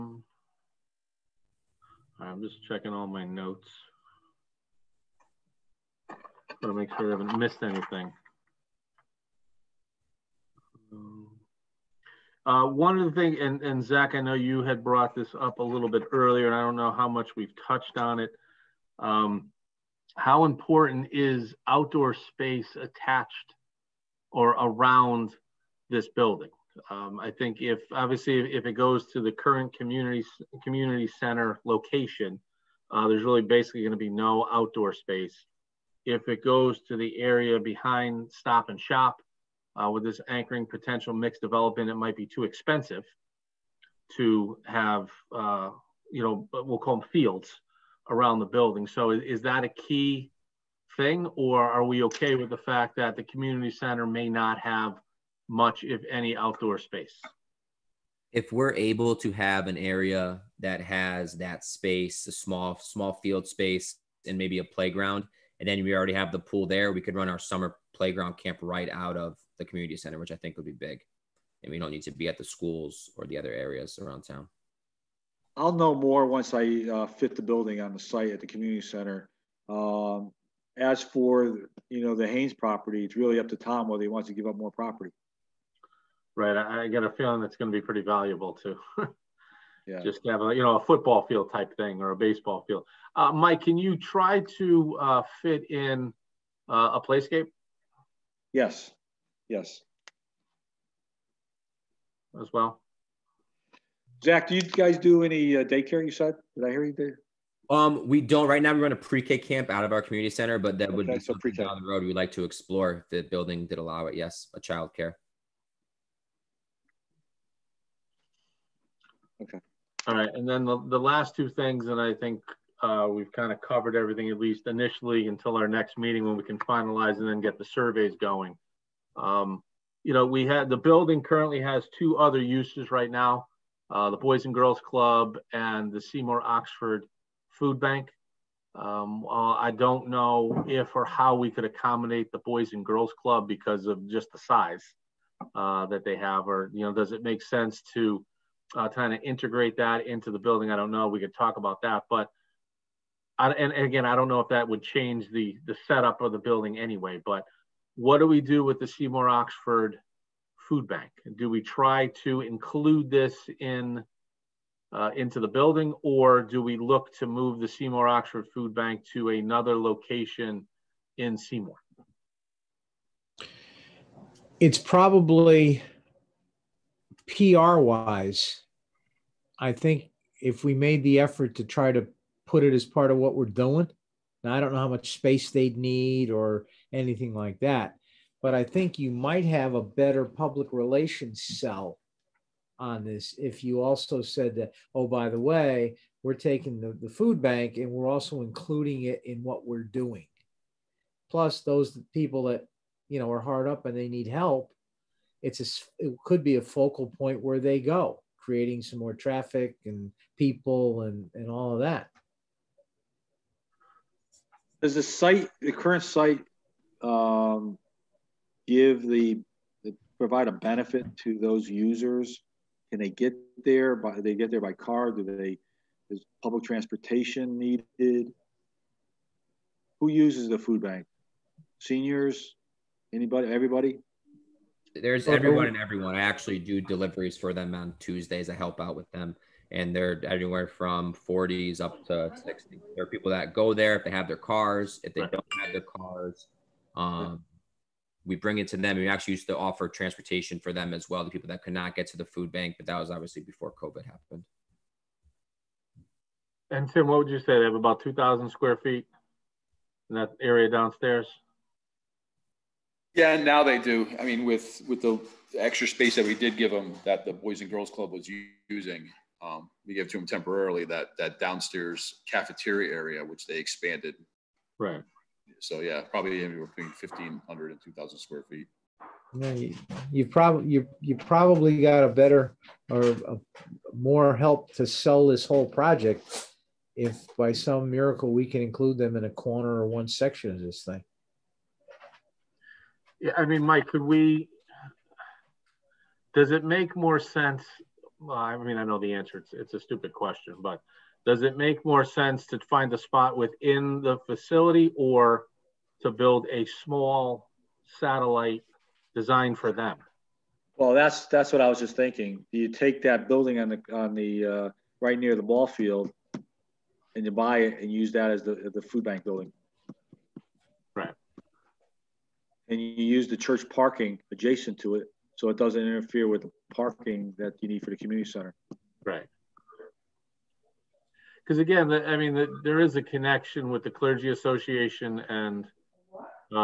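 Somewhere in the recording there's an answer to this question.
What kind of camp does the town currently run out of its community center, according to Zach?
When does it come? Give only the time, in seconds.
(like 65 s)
108 s.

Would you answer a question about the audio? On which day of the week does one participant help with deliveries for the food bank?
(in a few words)
Tuesdays.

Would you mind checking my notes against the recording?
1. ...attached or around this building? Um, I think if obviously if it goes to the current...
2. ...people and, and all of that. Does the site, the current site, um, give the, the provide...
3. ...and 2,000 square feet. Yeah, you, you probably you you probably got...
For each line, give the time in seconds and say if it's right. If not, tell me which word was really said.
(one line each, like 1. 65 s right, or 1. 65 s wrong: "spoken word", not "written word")
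1. 22 s right
2. 210 s right
3. 277 s right.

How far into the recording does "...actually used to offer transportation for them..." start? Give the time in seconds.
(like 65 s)
249 s.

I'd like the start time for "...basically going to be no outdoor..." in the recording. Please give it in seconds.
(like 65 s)
33 s.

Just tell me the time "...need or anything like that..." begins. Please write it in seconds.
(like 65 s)
185 s.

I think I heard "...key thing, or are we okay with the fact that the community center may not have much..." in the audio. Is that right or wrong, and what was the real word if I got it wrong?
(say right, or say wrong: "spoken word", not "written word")
right.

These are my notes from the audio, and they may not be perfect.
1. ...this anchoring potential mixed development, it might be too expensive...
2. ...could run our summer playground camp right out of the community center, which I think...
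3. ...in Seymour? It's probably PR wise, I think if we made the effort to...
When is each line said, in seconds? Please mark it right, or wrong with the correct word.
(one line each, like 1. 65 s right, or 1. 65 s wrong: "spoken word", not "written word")
1. 40 s right
2. 67 s right
3. 171 s right.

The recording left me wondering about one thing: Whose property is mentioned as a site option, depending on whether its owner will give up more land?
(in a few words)
Haynes property.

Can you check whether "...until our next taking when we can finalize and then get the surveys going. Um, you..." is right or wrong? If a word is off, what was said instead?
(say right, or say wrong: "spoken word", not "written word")
wrong: "meeting", not "taking".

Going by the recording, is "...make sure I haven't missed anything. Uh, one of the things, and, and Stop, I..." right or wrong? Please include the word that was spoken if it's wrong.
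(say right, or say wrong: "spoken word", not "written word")
wrong: "Zach", not "Stop".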